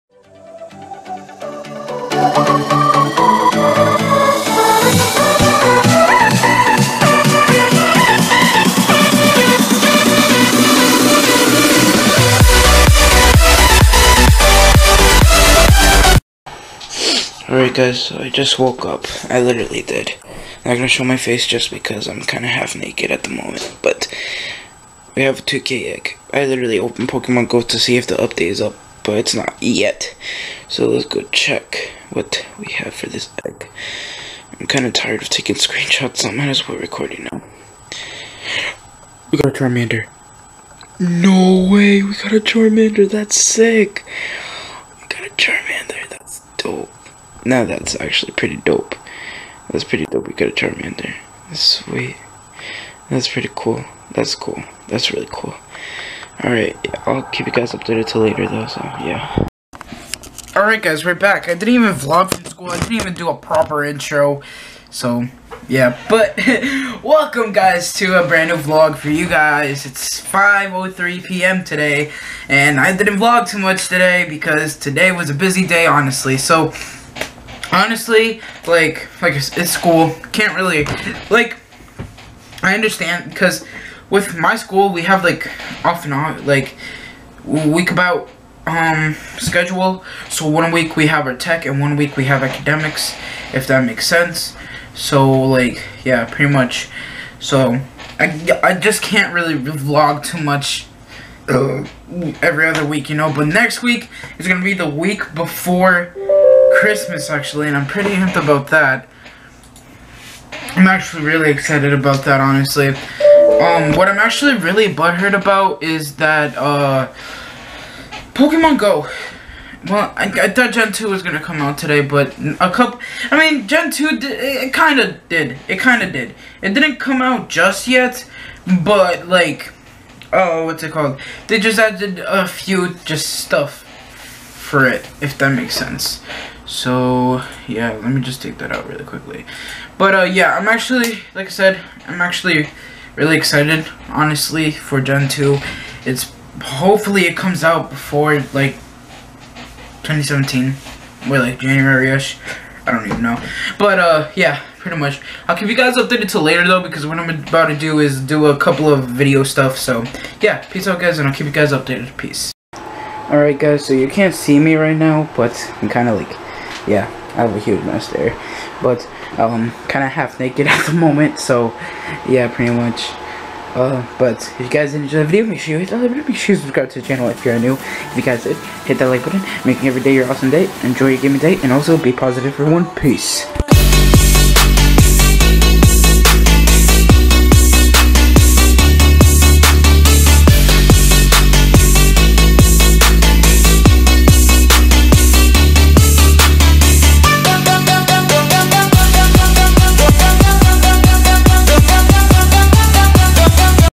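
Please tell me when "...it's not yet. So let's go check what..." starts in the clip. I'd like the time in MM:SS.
00:29.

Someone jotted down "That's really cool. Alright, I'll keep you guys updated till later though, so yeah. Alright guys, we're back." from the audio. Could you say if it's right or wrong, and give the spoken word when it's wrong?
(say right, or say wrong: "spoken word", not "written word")
right.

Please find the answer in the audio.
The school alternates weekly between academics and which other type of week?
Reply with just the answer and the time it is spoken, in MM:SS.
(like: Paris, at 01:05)
tech, at 01:31.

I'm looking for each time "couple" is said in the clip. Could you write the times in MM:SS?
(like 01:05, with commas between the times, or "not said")
02:02, 02:38.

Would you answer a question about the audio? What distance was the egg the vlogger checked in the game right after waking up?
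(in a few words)
2k.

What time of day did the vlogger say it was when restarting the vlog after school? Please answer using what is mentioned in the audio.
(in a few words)
5:03 p.m.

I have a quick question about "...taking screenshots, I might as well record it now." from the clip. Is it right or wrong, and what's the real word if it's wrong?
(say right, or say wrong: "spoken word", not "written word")
right.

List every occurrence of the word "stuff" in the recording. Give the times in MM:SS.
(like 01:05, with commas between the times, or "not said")
02:13, 02:39.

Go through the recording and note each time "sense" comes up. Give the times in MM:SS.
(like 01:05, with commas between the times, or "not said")
01:34, 02:15.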